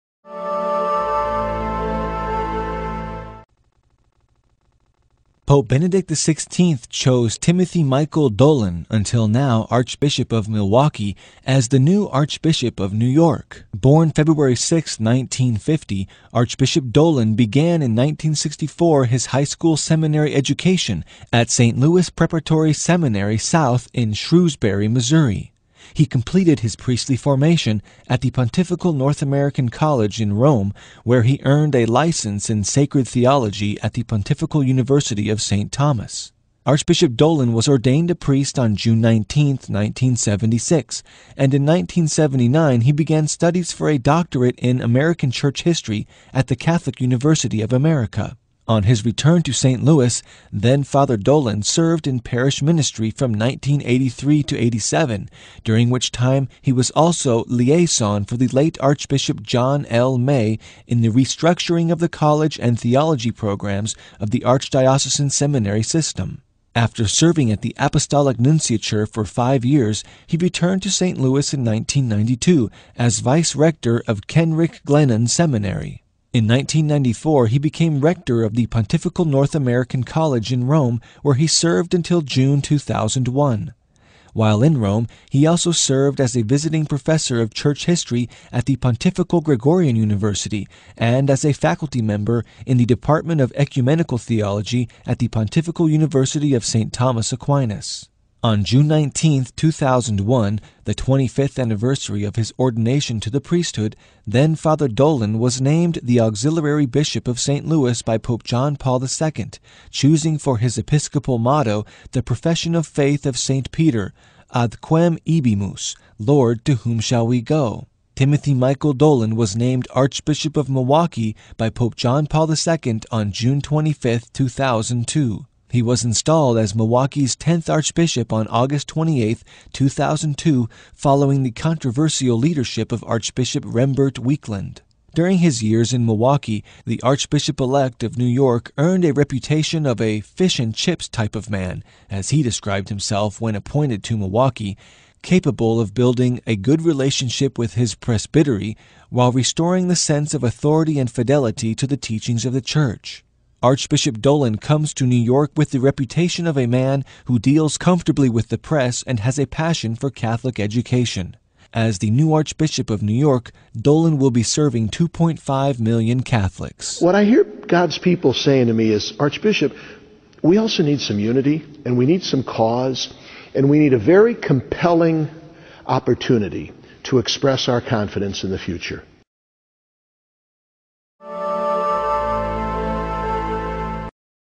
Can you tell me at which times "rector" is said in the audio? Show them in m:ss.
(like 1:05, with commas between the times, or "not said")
1:13, 1:17.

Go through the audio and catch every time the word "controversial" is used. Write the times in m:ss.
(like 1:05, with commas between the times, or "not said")
2:11.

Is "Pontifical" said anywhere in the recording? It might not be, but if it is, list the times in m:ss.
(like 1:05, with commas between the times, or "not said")
0:28, 0:34, 1:18, 1:28, 1:35.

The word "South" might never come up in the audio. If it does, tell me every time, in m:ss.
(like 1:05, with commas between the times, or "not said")
0:23.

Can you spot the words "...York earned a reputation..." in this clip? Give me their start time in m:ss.
2:18.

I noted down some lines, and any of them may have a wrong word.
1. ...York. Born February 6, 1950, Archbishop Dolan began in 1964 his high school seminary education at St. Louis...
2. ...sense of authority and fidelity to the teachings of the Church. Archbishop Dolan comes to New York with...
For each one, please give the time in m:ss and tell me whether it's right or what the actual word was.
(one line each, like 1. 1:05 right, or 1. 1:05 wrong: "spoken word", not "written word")
1. 0:13 right
2. 2:29 right.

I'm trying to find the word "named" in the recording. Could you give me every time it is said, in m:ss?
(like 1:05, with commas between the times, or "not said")
1:45, 1:59.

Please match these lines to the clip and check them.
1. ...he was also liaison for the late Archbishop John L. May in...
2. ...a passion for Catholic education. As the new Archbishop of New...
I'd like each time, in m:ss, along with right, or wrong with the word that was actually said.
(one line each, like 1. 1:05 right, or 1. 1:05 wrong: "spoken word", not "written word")
1. 0:56 right
2. 2:39 right.